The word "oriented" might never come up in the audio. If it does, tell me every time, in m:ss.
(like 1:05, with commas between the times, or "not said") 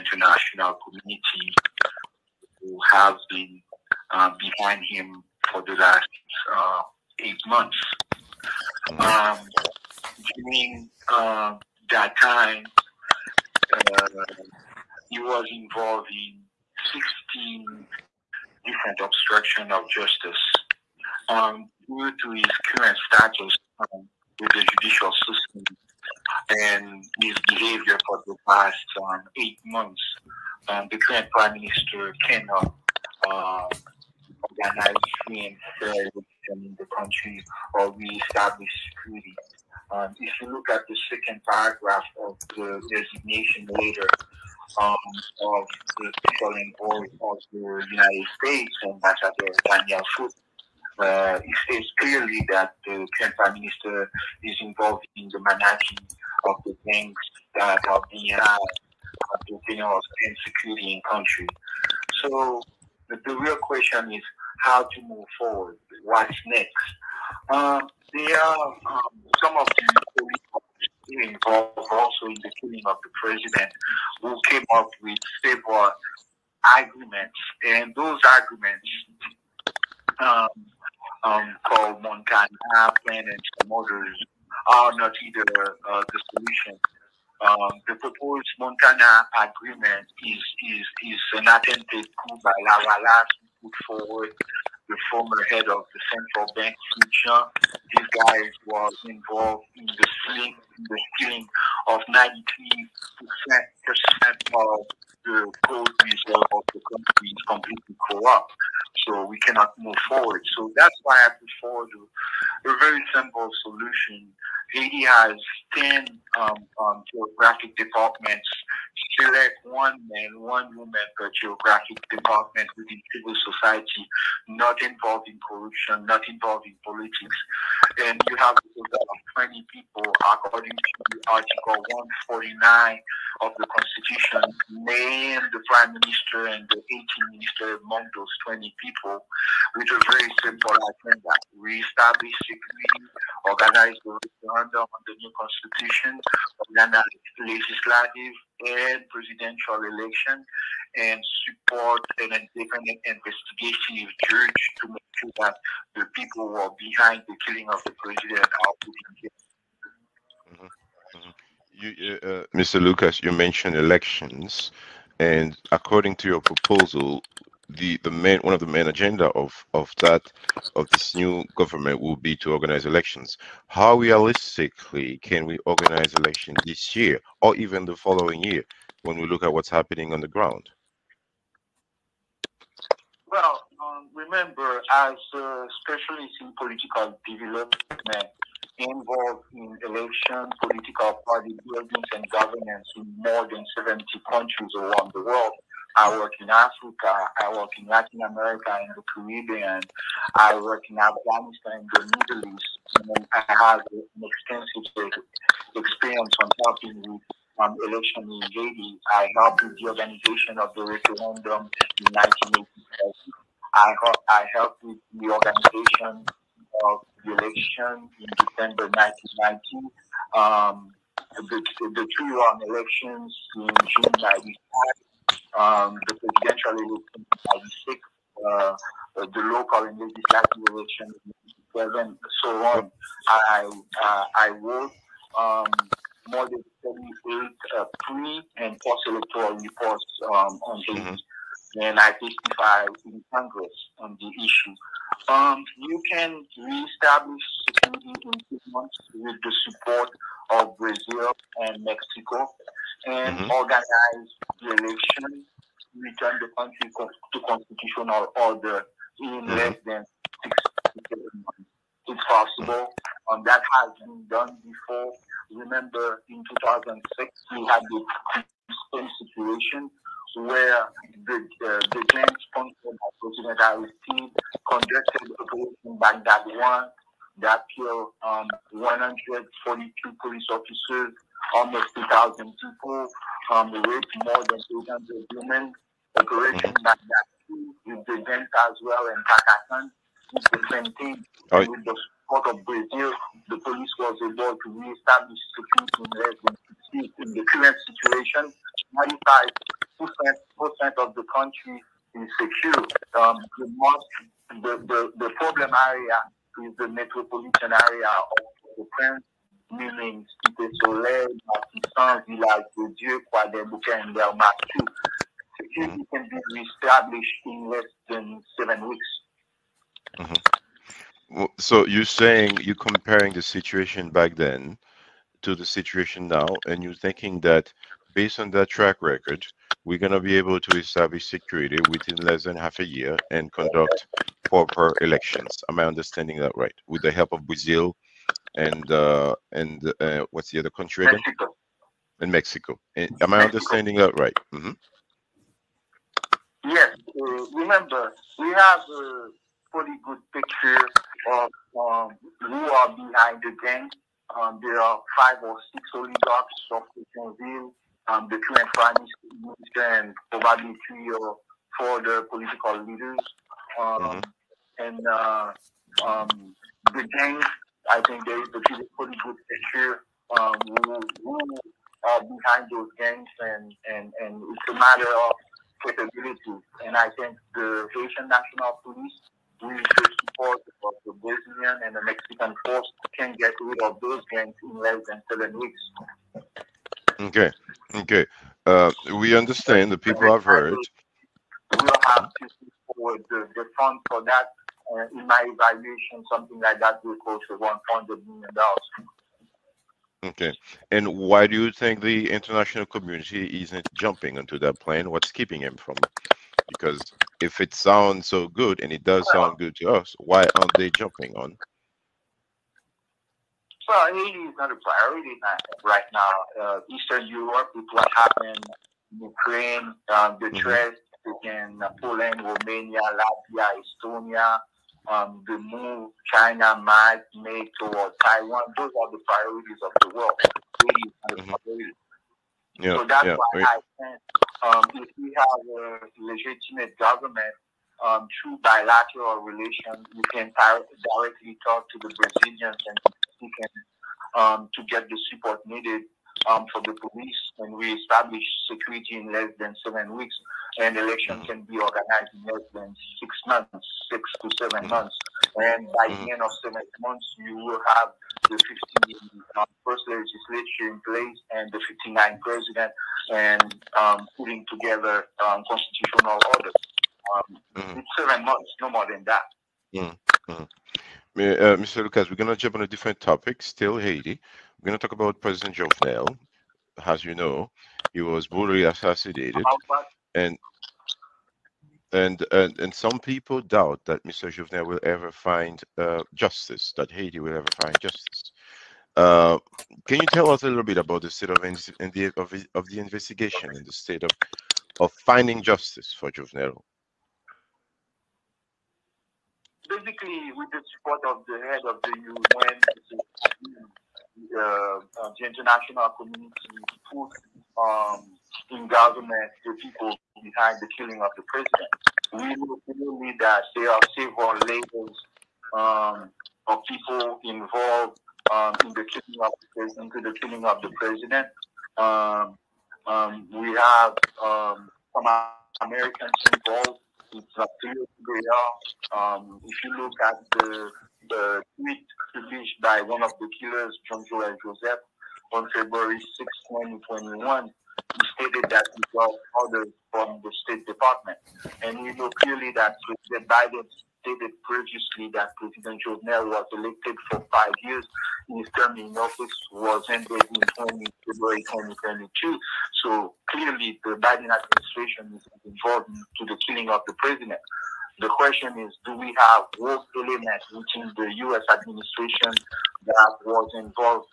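not said.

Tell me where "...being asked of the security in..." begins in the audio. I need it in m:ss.
0:58.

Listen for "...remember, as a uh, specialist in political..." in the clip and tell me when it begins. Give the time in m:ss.
3:04.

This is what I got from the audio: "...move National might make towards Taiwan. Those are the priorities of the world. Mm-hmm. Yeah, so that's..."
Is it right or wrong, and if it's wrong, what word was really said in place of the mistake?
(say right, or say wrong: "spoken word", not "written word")
wrong: "China", not "National".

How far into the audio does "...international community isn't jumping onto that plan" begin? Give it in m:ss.
6:42.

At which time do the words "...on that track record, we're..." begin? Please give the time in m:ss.
5:28.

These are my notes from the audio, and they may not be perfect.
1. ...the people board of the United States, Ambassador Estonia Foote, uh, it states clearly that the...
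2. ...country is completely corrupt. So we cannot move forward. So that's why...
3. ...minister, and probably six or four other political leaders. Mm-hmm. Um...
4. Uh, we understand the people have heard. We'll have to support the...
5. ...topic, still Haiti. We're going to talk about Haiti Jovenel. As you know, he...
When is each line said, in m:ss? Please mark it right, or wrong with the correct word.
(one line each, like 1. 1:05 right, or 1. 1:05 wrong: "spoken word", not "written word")
1. 0:45 wrong: "Daniel", not "Estonia"
2. 1:46 right
3. 5:58 wrong: "three", not "six"
4. 6:28 right
5. 7:53 wrong: "President", not "Haiti".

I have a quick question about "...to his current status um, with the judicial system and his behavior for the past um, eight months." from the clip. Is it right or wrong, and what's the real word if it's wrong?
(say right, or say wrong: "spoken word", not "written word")
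right.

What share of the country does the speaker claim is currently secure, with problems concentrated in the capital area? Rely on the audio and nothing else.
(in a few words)
95%.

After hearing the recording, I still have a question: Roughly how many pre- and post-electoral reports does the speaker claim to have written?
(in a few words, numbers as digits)
78.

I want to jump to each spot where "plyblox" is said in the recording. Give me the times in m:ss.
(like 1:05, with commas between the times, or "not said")
not said.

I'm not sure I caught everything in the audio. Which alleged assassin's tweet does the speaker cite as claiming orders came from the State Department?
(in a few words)
John Joel Joseph.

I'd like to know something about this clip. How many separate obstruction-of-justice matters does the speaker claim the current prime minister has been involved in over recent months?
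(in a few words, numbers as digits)
16.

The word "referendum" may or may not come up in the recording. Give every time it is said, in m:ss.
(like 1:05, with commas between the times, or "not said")
2:24, 3:30.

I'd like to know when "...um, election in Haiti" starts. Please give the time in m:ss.
3:27.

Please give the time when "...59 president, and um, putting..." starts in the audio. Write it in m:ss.
7:42.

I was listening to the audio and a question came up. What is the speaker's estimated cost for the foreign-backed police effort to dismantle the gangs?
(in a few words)
$100 million.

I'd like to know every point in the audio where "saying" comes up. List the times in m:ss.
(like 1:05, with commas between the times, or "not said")
5:22.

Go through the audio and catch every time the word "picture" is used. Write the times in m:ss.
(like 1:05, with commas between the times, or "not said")
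5:50, 6:09.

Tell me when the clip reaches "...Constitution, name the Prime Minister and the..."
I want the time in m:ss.
2:13.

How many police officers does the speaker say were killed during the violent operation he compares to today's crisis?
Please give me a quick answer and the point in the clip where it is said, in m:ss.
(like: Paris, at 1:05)
142, at 4:38.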